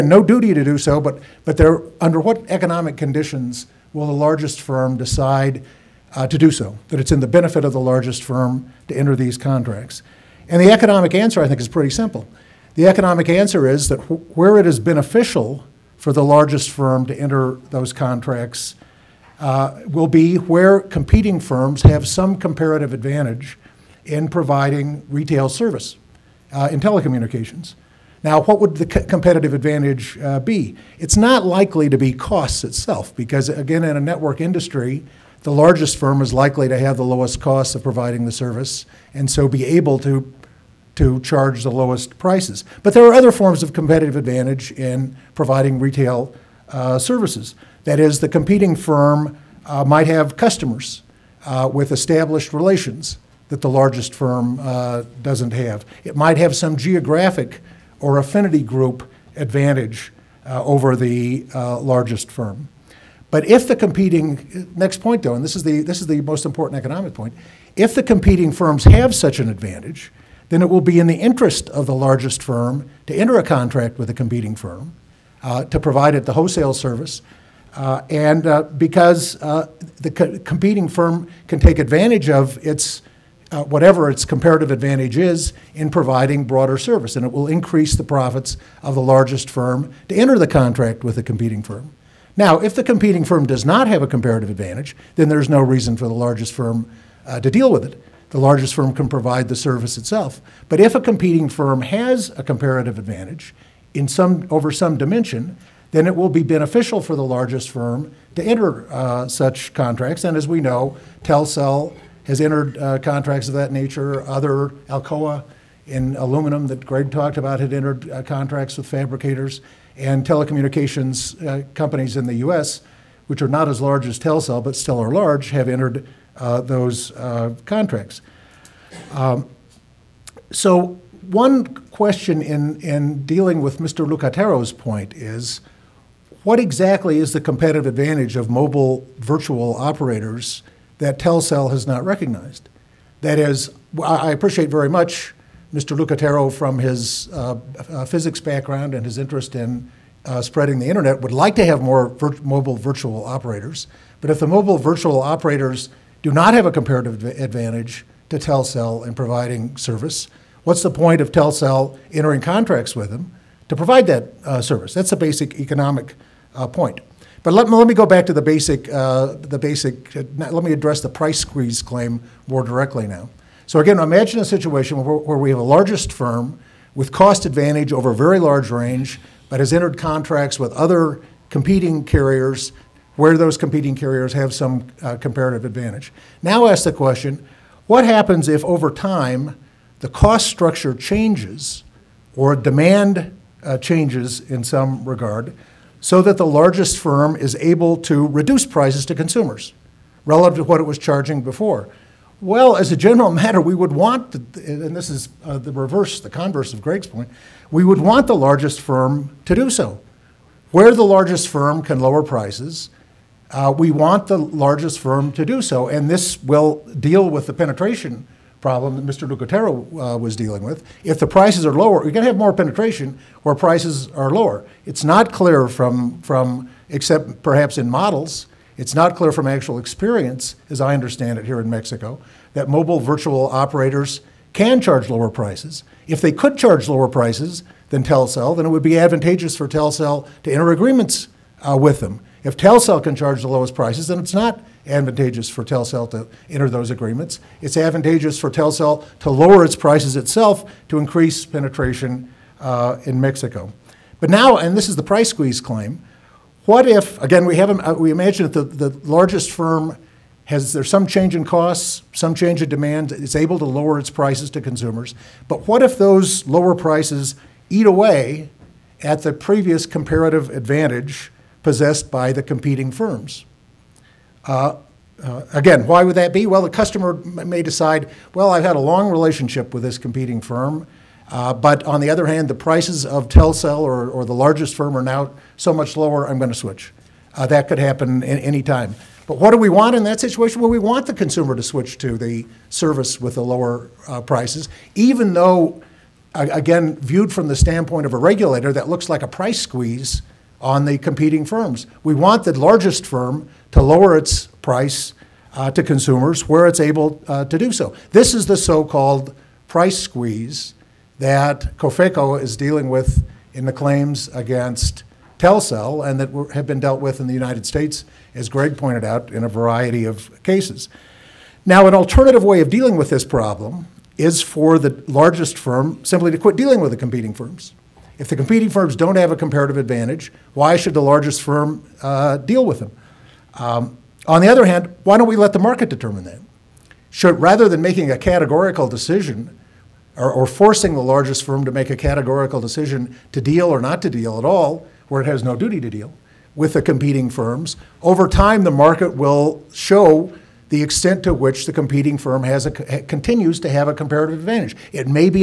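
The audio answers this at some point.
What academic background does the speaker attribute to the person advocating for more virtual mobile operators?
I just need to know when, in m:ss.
2:28.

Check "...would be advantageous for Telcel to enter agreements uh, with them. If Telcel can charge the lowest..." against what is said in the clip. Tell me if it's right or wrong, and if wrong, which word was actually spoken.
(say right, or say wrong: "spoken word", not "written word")
right.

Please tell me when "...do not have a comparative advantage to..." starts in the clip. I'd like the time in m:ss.
2:36.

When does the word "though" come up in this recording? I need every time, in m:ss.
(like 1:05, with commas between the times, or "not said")
1:05, 4:55.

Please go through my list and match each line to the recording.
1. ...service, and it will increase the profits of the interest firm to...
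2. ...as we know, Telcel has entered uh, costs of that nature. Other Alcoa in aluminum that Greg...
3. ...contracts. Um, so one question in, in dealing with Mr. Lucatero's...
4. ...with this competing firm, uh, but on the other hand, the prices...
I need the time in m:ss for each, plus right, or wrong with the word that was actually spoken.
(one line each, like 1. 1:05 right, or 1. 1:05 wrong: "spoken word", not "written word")
1. 1:26 wrong: "largest", not "interest"
2. 1:50 wrong: "contracts", not "costs"
3. 2:07 right
4. 4:39 right.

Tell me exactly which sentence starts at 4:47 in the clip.
Uh, that could happen any time.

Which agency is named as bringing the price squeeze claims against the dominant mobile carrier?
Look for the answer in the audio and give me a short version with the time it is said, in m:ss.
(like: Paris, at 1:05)
Cofeco, at 5:11.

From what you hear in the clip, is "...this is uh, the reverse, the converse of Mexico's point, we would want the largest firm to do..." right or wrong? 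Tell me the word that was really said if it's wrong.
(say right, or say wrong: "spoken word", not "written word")
wrong: "Greg", not "Mexico".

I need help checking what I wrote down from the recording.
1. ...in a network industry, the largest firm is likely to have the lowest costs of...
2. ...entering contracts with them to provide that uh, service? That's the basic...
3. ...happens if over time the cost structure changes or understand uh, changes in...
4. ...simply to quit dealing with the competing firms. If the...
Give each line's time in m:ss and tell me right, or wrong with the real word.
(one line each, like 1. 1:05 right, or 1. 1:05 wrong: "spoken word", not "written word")
1. 0:33 right
2. 2:42 right
3. 3:08 wrong: "demand", not "understand"
4. 5:26 right.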